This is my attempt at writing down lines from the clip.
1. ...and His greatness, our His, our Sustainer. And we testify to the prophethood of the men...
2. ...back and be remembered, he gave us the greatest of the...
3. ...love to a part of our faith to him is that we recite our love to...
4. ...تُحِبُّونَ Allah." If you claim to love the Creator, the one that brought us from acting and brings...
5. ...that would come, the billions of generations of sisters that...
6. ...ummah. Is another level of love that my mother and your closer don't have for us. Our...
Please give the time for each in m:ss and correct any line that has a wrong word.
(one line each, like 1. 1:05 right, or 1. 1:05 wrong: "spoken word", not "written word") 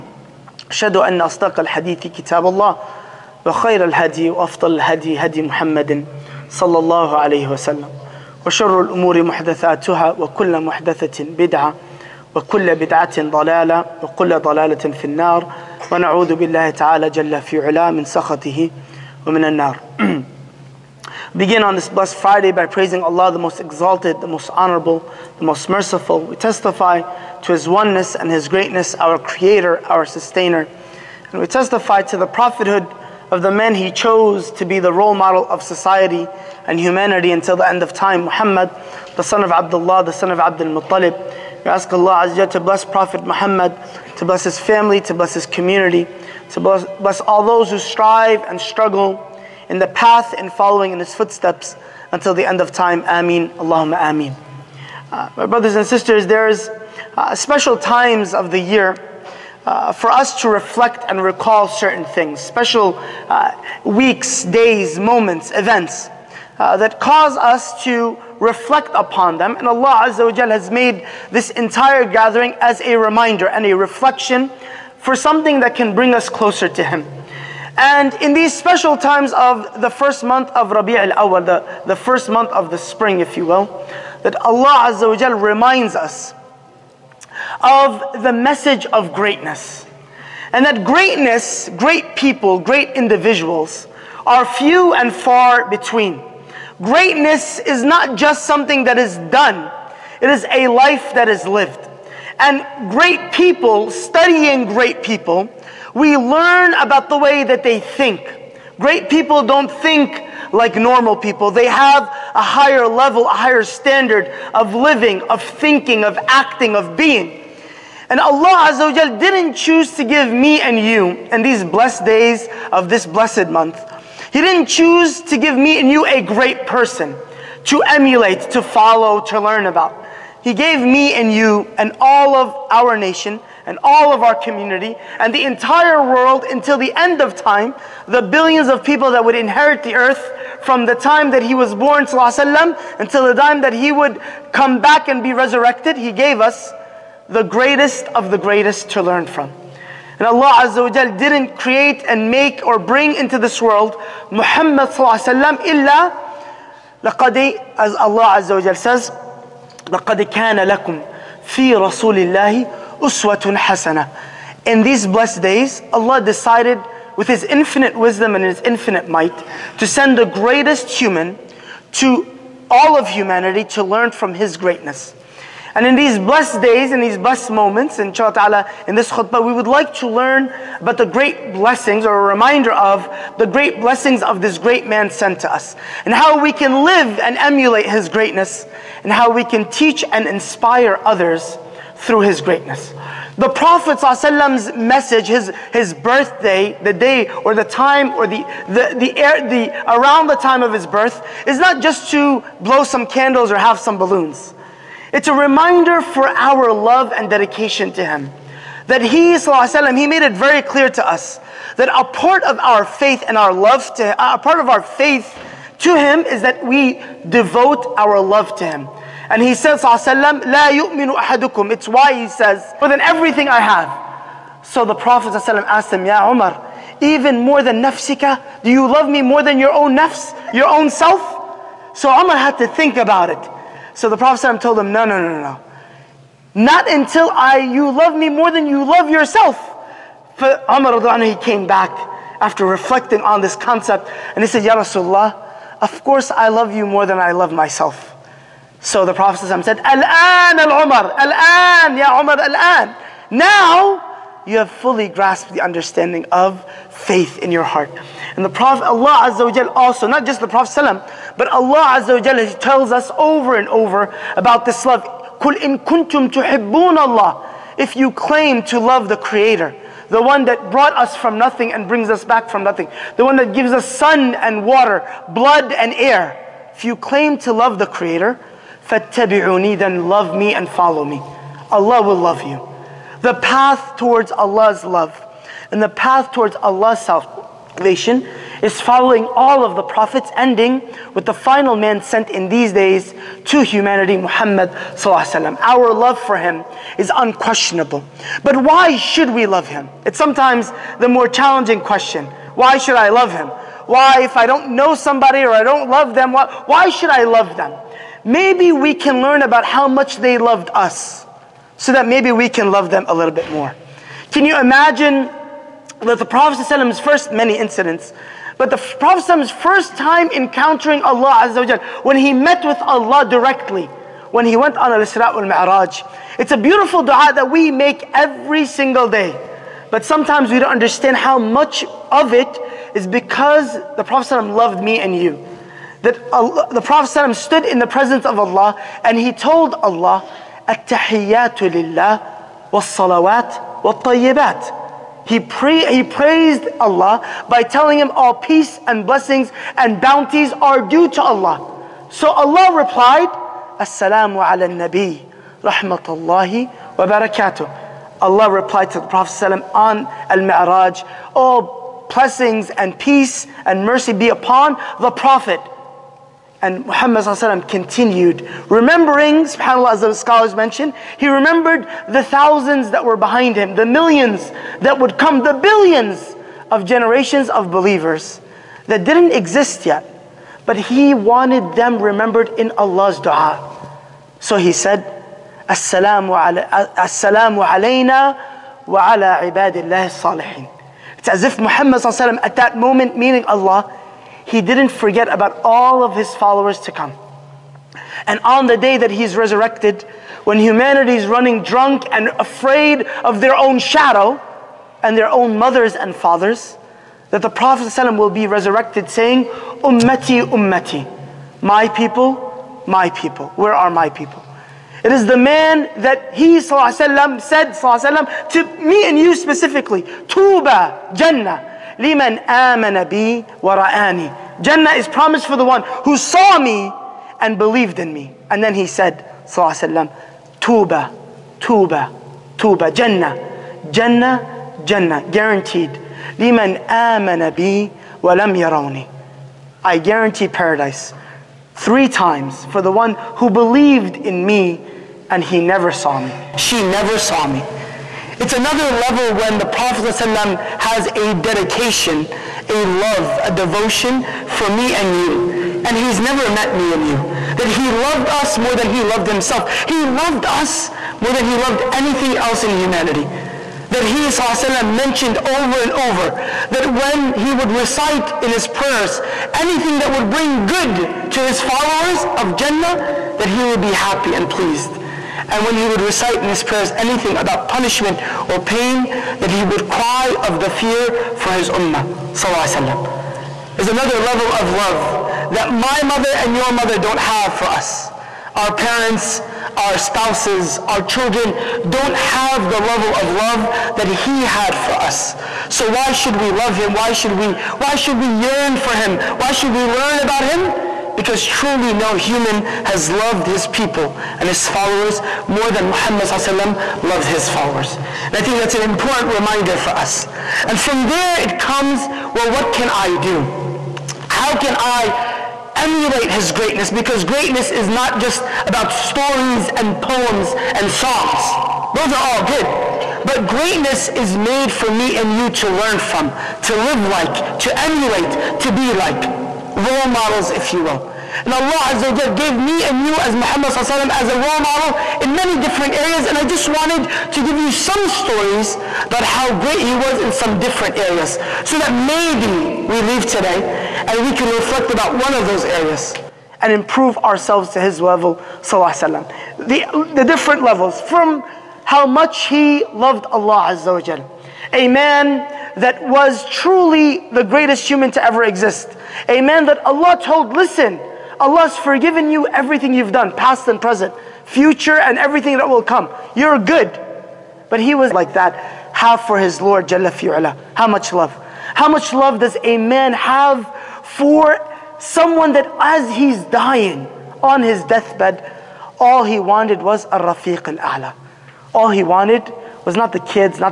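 1. 0:28 wrong: "Creator", not "His"
2. 2:24 wrong: "resurrected", not "remembered"
3. 3:33 wrong: "devote", not "recite"
4. 4:26 wrong: "nothing", not "acting"
5. 6:14 wrong: "believers", not "sisters"
6. 8:01 wrong: "mother", not "closer".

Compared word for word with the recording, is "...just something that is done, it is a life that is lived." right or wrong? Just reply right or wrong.
right.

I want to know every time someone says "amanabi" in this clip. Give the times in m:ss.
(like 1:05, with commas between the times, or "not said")
7:02, 7:16.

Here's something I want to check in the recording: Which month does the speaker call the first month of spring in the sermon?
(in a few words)
Rabi' al Awal.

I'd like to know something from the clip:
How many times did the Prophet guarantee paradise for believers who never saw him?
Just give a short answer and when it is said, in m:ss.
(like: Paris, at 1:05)
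3, at 7:21.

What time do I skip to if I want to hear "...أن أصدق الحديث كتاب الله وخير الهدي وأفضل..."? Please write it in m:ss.
0:00.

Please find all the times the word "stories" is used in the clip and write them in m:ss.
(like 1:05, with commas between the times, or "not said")
8:38, 8:58.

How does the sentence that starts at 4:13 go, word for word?
Now you have fully grasped the understanding of faith in your heart.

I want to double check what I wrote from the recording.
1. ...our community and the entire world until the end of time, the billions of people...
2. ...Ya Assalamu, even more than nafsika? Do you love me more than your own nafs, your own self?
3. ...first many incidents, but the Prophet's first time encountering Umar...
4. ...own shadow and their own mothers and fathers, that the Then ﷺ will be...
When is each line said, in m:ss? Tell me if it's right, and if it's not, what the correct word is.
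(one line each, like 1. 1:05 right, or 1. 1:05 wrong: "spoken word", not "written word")
1. 2:14 right
2. 3:46 wrong: "Umar", not "Assalamu"
3. 5:16 wrong: "Allah", not "Umar"
4. 6:43 wrong: "Prophet", not "Then".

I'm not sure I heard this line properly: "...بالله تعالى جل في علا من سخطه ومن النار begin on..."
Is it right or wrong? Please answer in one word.
right.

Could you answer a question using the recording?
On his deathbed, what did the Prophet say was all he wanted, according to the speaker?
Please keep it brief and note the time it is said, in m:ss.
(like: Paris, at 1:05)
rafiq al-a'la, at 9:40.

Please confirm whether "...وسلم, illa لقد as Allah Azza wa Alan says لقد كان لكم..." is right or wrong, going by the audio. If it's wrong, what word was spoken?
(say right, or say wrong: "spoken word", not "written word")
wrong: "Jal", not "Alan".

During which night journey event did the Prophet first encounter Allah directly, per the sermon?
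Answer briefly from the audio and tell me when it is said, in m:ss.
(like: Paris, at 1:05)
Al-Isra' al miraj, at 5:24.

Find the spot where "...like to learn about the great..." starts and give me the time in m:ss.
2:59.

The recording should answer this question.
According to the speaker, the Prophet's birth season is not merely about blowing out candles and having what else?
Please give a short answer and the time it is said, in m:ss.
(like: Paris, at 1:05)
balloons, at 3:23.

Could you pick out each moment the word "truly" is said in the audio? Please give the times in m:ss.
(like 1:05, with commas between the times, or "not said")
8:21, 9:16.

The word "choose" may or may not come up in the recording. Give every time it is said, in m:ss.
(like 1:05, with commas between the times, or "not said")
1:59, 2:04.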